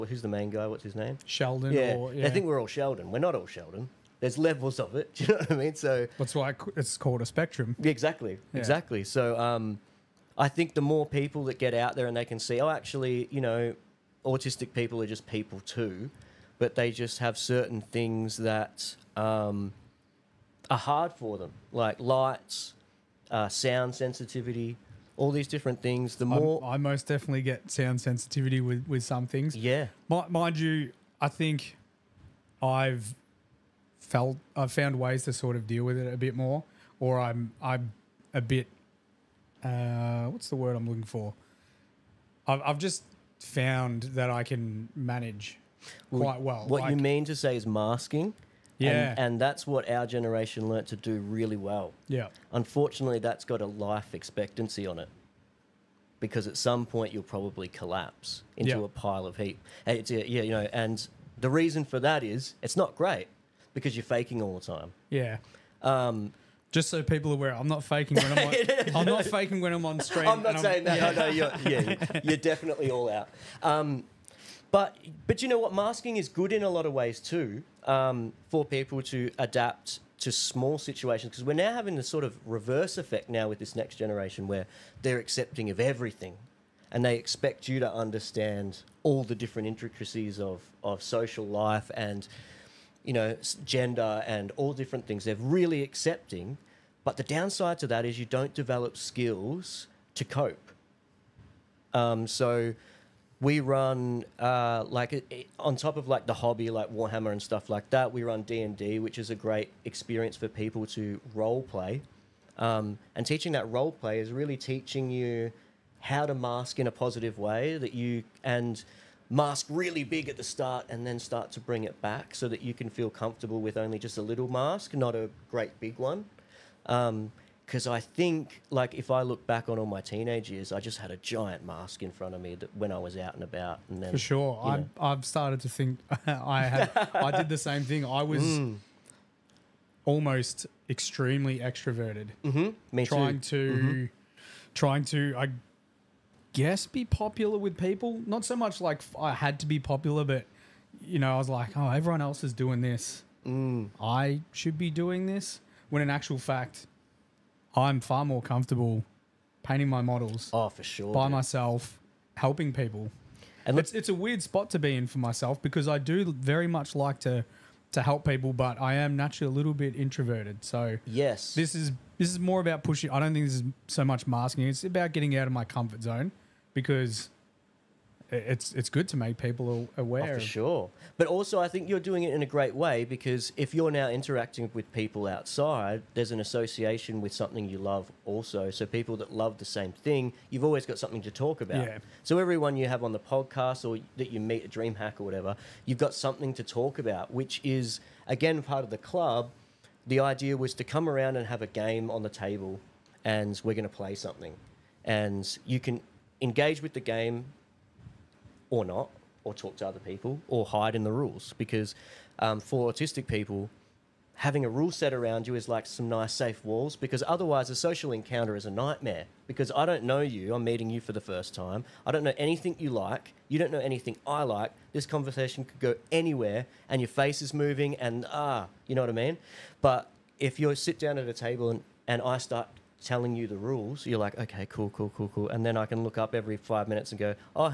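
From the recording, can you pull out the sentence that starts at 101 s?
Um, so we run uh, like it, it, on top of like the hobby, like Warhammer and stuff like that.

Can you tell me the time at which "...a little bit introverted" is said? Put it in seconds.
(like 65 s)
169 s.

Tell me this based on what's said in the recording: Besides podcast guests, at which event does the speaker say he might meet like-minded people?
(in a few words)
DreamHack.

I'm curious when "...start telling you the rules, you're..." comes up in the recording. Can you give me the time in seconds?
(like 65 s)
232 s.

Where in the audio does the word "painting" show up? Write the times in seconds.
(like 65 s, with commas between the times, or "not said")
159 s.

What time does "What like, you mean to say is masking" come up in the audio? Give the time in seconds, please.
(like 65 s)
46 s.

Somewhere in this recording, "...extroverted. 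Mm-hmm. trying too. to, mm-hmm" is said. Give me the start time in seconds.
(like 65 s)
141 s.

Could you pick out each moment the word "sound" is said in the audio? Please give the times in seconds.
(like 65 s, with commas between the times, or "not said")
23 s, 27 s.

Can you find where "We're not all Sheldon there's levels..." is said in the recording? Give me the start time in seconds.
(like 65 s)
3 s.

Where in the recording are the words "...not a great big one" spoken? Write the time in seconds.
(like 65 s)
124 s.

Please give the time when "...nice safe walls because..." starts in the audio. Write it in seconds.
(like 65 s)
216 s.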